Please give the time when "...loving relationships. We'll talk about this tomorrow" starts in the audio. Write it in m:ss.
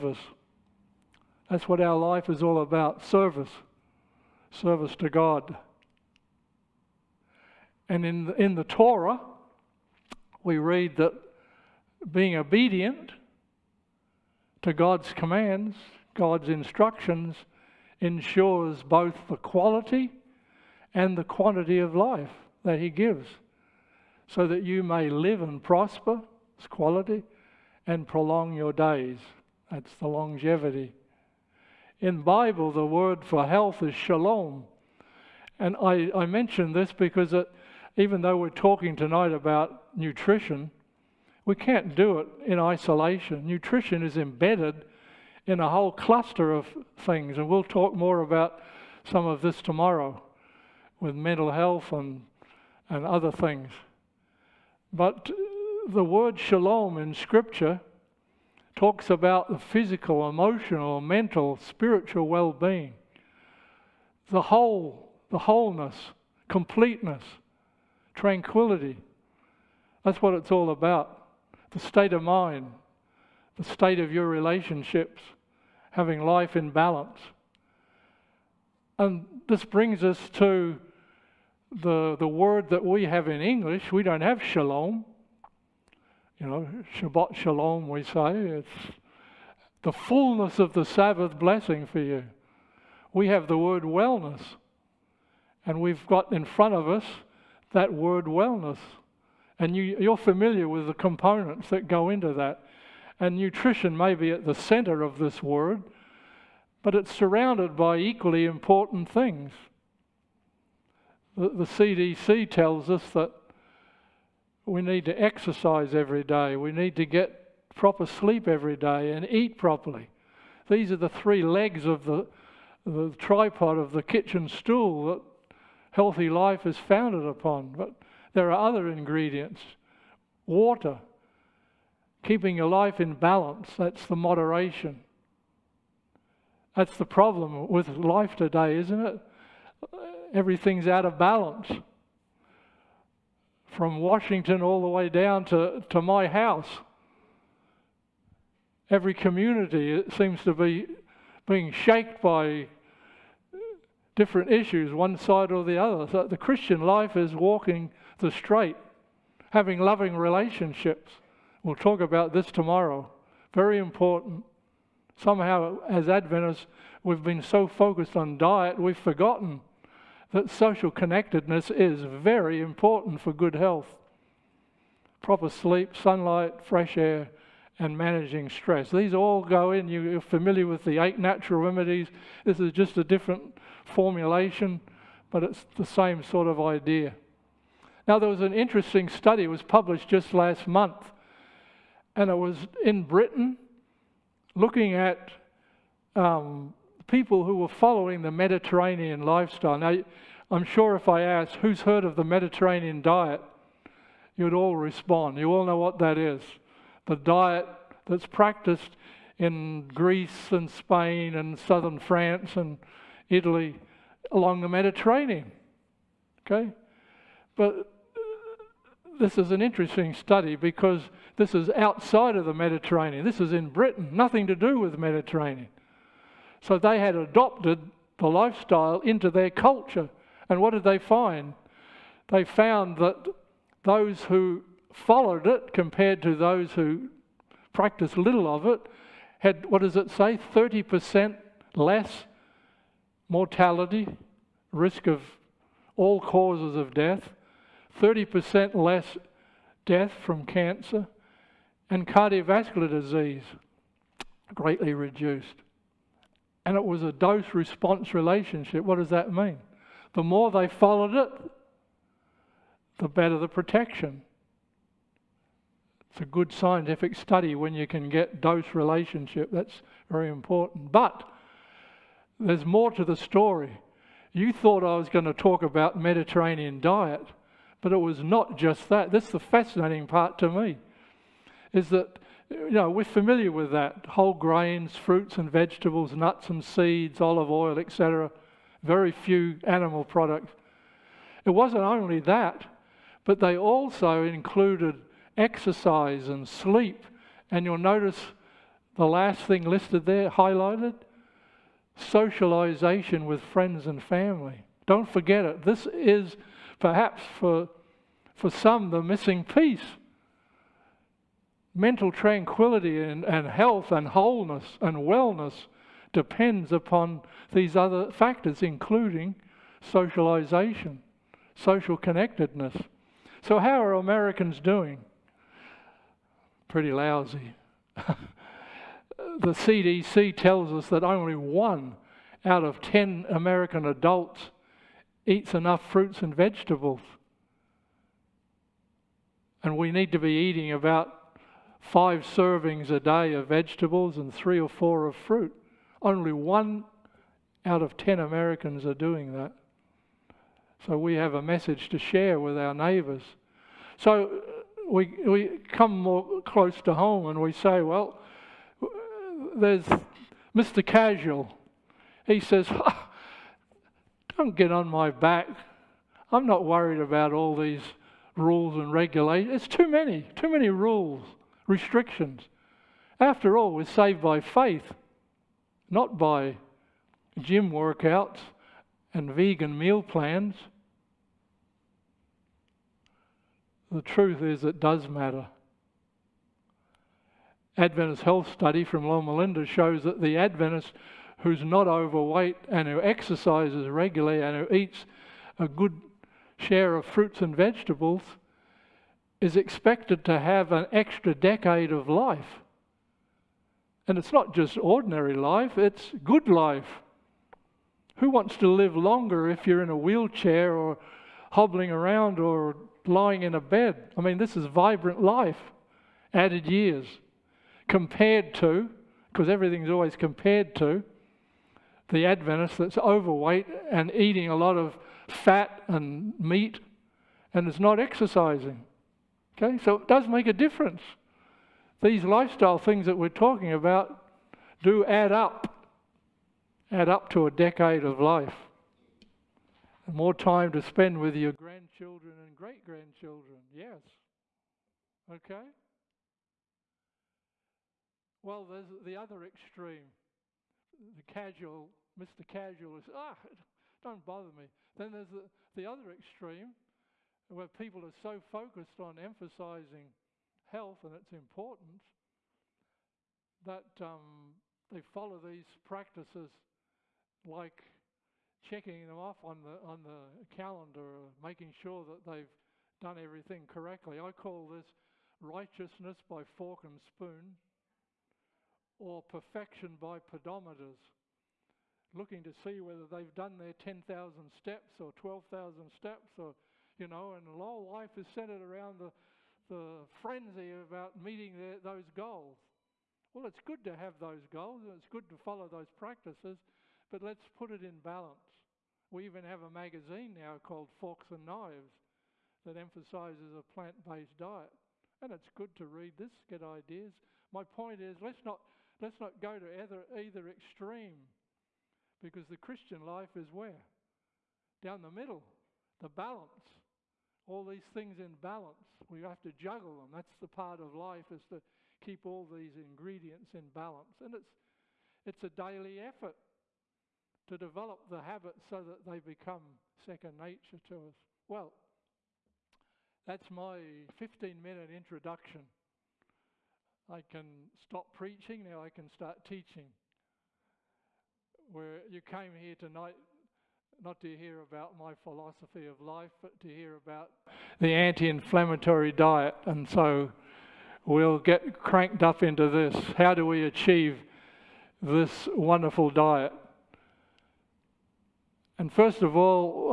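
2:39.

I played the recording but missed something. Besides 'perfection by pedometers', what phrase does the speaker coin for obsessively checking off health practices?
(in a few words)
righteousness by fork and spoon.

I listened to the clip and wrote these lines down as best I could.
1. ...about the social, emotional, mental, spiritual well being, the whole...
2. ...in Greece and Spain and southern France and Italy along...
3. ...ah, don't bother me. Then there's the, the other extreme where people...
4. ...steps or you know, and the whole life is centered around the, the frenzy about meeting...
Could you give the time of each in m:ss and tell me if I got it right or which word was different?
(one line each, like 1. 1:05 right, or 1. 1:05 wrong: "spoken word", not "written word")
1. 0:59 wrong: "physical", not "social"
2. 3:29 right
3. 7:33 right
4. 8:05 right.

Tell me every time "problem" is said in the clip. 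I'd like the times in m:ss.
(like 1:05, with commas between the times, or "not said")
2:17.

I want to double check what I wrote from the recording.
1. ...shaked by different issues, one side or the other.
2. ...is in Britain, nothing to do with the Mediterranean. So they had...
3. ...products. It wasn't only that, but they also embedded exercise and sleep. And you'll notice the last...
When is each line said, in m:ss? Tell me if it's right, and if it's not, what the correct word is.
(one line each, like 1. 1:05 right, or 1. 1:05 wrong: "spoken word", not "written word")
1. 2:31 right
2. 3:43 right
3. 4:50 wrong: "included", not "embedded".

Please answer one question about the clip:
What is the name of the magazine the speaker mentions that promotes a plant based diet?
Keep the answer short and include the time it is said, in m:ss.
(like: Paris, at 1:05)
Forks and Knives, at 8:20.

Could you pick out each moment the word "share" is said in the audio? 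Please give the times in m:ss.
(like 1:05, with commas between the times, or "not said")
5:51, 6:36.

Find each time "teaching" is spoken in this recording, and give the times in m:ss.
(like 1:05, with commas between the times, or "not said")
8:59.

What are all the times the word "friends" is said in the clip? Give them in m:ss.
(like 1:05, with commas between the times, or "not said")
5:03.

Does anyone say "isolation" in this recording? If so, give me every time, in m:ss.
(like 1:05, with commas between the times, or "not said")
0:42.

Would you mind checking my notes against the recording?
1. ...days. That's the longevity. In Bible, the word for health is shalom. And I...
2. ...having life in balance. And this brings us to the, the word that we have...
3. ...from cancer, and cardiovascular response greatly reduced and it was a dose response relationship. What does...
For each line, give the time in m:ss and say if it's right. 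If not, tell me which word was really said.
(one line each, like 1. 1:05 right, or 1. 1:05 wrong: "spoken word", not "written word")
1. 0:28 right
2. 1:15 right
3. 4:10 wrong: "disease", not "response".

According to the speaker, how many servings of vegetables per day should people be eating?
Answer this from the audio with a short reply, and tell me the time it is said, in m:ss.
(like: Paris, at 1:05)
5, at 5:41.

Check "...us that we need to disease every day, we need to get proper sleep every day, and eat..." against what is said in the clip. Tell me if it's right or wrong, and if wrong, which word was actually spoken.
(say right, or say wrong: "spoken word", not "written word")
wrong: "exercise", not "disease".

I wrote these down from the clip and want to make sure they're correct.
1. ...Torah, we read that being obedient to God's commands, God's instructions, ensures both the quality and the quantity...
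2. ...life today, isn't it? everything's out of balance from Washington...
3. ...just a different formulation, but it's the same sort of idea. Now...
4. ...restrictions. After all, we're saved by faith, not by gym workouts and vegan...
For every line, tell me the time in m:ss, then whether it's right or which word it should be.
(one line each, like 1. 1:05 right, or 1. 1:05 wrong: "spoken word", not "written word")
1. 0:08 right
2. 2:17 right
3. 3:02 right
4. 6:11 right.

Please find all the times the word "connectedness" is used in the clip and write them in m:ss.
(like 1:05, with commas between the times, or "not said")
2:50, 5:21.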